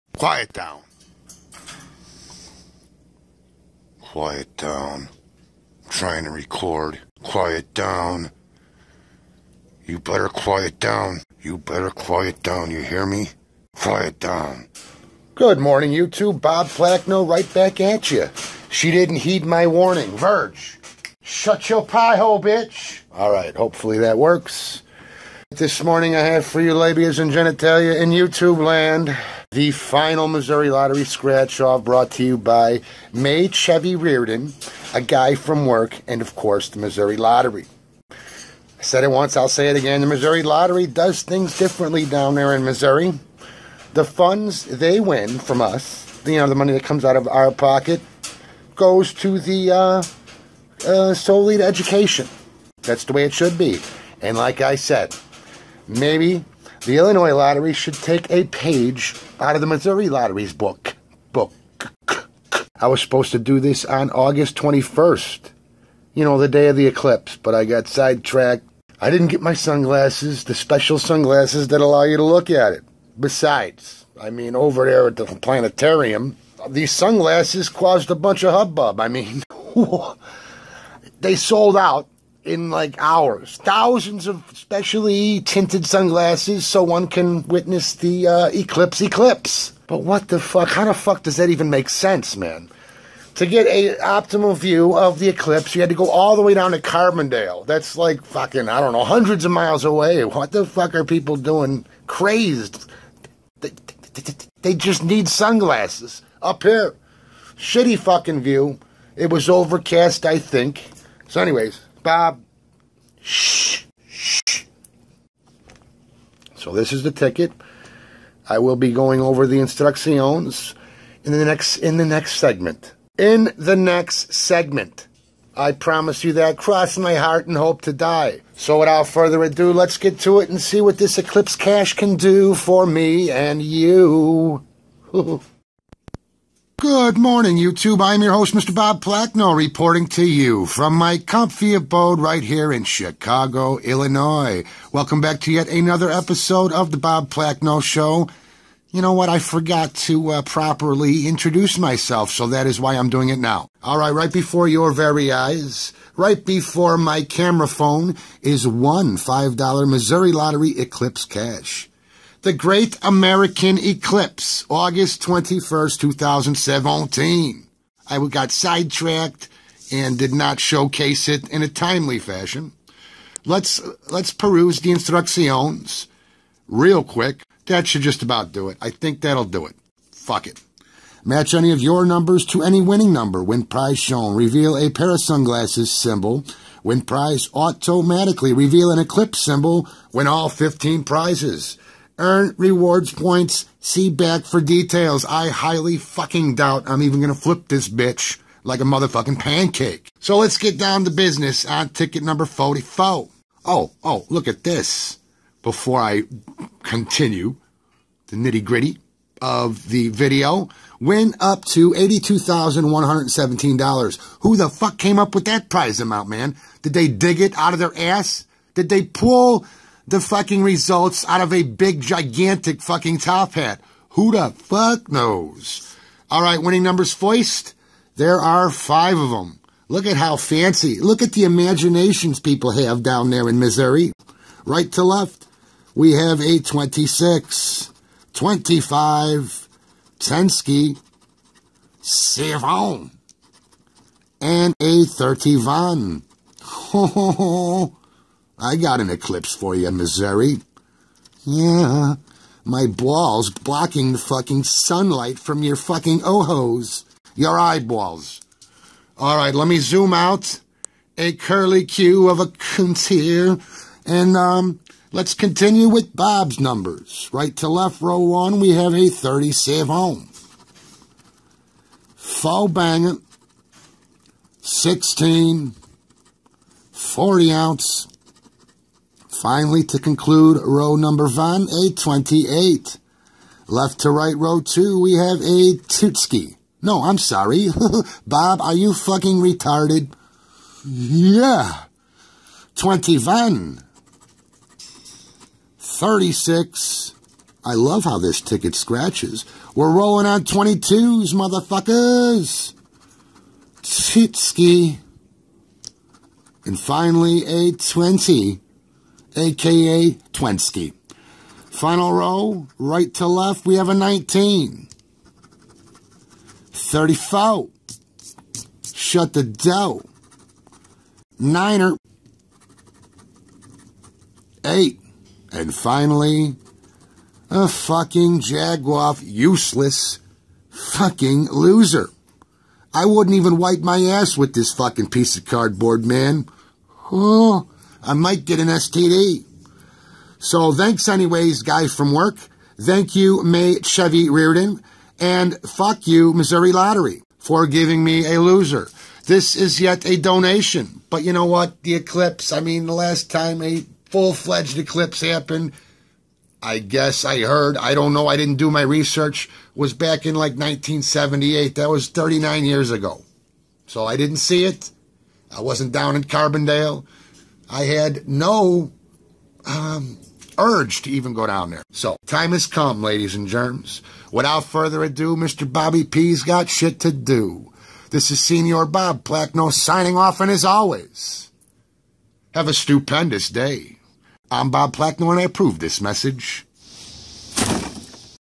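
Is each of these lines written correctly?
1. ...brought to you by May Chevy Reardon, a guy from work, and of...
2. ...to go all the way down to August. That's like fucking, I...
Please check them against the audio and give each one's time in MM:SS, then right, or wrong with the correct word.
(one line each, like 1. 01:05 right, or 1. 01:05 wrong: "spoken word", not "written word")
1. 00:31 right
2. 01:35 wrong: "Carbondale", not "August".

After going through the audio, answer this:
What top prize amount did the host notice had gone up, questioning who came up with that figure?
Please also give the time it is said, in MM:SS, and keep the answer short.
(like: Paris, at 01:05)
$82,117, at 03:31.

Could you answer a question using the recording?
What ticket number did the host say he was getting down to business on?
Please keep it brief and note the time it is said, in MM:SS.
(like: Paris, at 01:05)
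44, at 03:22.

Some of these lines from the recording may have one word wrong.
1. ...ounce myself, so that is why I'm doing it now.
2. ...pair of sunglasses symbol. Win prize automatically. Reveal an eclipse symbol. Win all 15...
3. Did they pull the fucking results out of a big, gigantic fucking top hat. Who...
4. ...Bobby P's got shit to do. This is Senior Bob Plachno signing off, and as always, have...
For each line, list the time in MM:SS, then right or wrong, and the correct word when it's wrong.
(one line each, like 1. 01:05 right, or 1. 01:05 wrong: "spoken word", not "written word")
1. 02:31 wrong: "introduce", not "ounce"
2. 03:04 right
3. 03:38 right
4. 06:15 right.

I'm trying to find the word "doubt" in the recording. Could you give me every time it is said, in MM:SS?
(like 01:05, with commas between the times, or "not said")
03:16.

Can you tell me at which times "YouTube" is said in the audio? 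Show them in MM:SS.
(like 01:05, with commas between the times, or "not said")
00:28, 02:17.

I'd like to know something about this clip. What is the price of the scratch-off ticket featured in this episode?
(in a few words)
$5.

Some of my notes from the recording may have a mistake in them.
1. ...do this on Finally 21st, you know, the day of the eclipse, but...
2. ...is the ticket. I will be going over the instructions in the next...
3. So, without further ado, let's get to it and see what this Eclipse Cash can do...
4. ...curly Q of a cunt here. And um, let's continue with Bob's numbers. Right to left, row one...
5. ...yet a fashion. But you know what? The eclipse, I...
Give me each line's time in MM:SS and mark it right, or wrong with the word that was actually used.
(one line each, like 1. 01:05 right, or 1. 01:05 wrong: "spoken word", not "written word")
1. 01:03 wrong: "August", not "Finally"
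2. 01:56 right
3. 02:08 right
4. 04:21 right
5. 05:49 wrong: "donation", not "fashion".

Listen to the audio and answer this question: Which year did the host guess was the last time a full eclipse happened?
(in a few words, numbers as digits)
1978.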